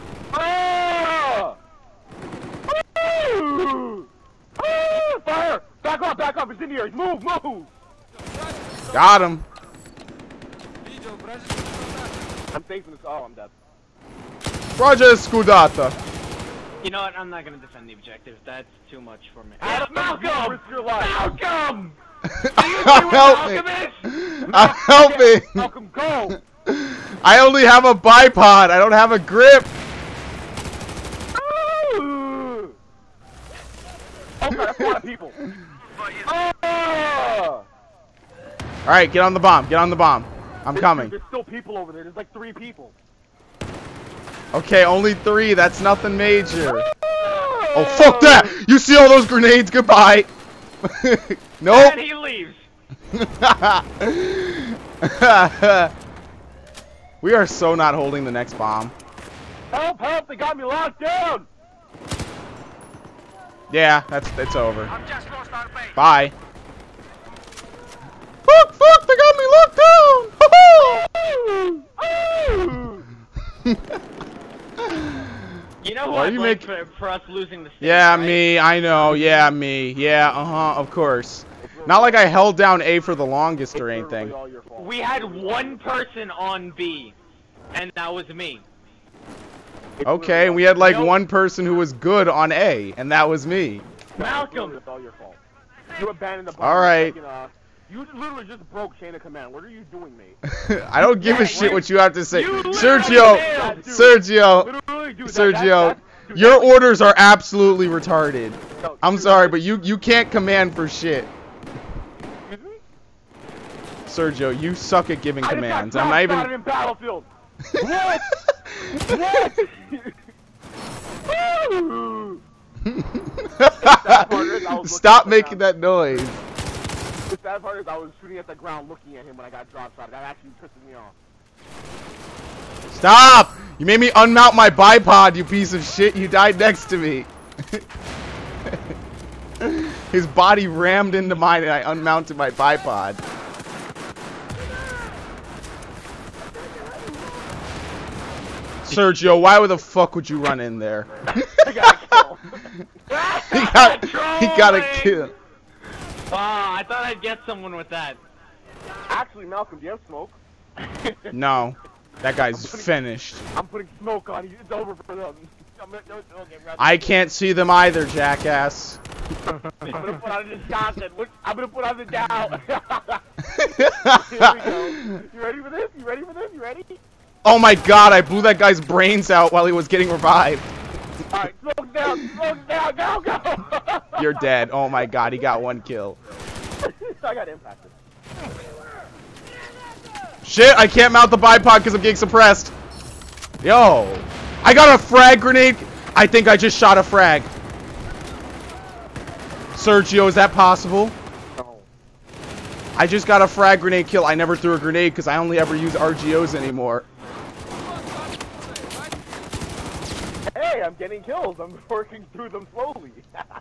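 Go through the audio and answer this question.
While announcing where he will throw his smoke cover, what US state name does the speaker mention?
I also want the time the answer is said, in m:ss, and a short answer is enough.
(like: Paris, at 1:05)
Wisconsin, at 2:50.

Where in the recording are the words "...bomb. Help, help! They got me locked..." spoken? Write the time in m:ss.
0:58.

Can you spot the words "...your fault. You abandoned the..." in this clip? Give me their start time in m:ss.
1:35.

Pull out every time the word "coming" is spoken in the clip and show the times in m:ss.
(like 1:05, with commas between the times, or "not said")
0:40.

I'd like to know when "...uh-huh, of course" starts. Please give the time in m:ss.
1:20.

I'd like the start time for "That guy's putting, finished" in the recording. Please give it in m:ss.
2:42.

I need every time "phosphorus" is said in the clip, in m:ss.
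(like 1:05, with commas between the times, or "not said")
not said.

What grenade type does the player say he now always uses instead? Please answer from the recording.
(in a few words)
RGOs.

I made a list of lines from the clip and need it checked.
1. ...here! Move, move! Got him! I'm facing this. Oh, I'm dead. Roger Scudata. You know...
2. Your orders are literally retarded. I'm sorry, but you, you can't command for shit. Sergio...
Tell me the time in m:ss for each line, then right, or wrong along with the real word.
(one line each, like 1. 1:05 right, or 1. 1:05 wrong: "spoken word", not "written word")
1. 0:06 right
2. 1:46 wrong: "absolutely", not "literally".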